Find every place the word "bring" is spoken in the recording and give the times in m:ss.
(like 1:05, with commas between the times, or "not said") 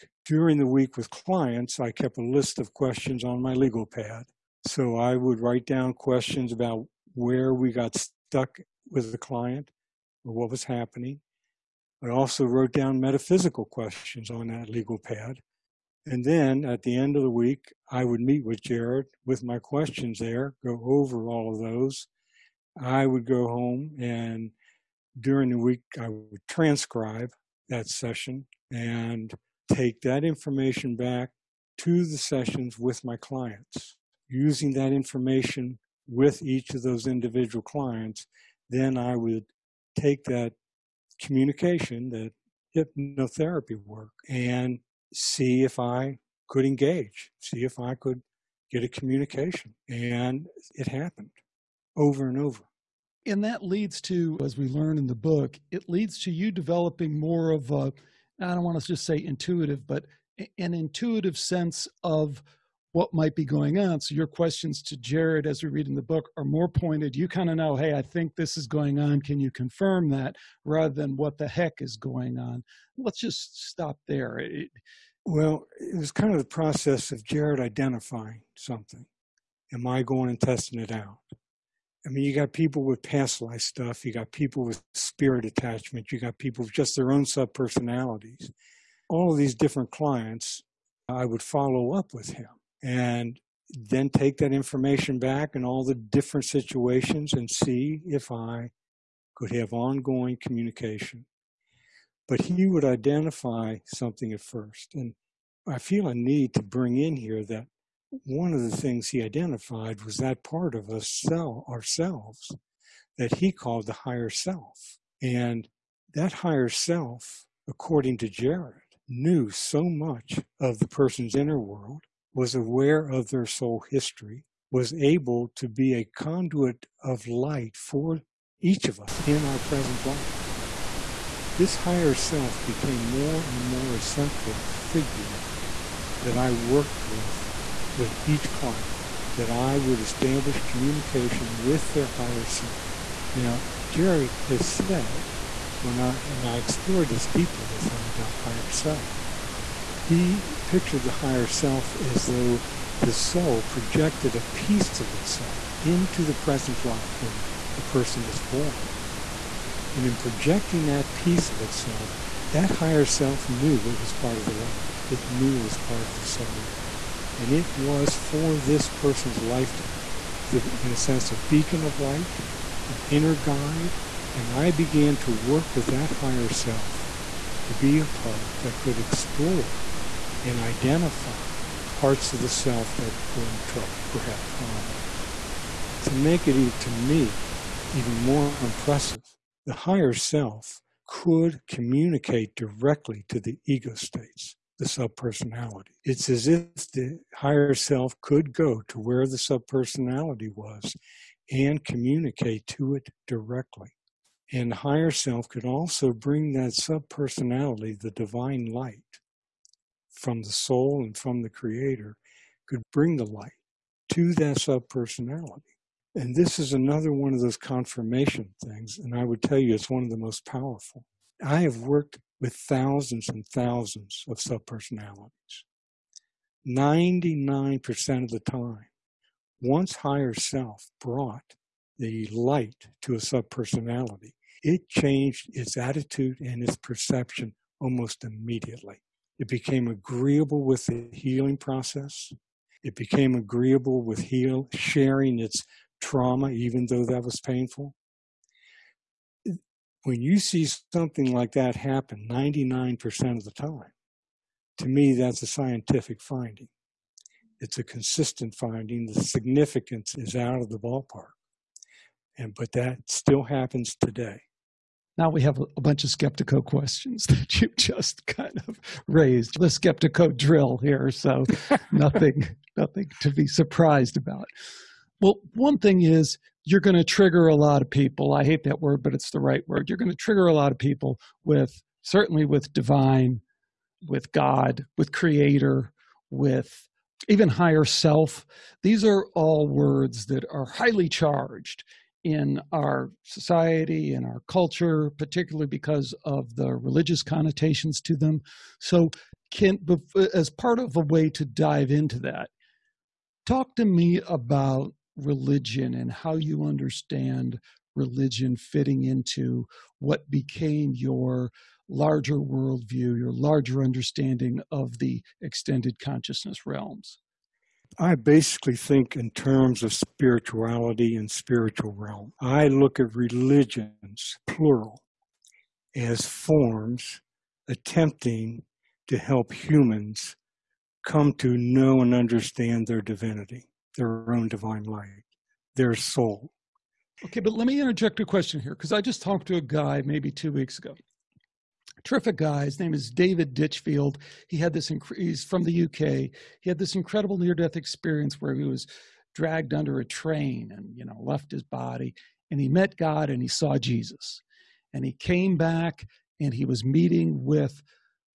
1:46, 3:26, 3:32.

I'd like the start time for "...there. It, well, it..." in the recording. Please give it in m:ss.
1:14.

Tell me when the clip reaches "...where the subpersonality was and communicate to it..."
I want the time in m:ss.
3:18.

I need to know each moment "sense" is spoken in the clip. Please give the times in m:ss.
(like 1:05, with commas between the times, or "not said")
1:01, 2:50.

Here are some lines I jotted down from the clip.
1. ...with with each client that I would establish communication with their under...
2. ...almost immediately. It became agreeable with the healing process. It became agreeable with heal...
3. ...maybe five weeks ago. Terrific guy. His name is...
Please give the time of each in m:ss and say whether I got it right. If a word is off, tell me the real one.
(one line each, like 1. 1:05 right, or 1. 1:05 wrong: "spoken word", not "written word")
1. 2:17 wrong: "higher", not "under"
2. 3:57 right
3. 5:40 wrong: "two", not "five".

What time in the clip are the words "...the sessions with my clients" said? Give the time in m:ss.
0:32.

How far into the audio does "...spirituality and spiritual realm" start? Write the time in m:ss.
5:19.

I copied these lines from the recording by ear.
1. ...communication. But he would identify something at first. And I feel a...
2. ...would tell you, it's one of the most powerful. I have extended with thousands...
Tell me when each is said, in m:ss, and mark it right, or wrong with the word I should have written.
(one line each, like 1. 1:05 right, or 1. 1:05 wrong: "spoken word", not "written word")
1. 1:40 right
2. 3:39 wrong: "worked", not "extended".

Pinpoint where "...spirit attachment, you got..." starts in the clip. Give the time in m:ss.
1:24.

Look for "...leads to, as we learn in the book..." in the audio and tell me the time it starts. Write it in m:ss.
0:53.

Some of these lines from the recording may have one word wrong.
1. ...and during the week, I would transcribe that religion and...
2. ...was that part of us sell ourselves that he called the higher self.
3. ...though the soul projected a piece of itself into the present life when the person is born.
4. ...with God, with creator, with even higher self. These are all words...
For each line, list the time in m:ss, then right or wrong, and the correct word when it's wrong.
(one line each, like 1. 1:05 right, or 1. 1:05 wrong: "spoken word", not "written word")
1. 0:23 wrong: "session", not "religion"
2. 1:50 right
3. 2:32 right
4. 4:44 right.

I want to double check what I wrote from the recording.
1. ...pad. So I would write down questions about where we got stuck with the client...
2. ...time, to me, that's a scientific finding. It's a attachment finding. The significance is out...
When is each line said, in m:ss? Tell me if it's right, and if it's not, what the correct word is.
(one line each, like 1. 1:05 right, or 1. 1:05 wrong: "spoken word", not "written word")
1. 0:03 right
2. 4:13 wrong: "consistent", not "attachment".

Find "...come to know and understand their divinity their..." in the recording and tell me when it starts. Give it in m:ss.
5:31.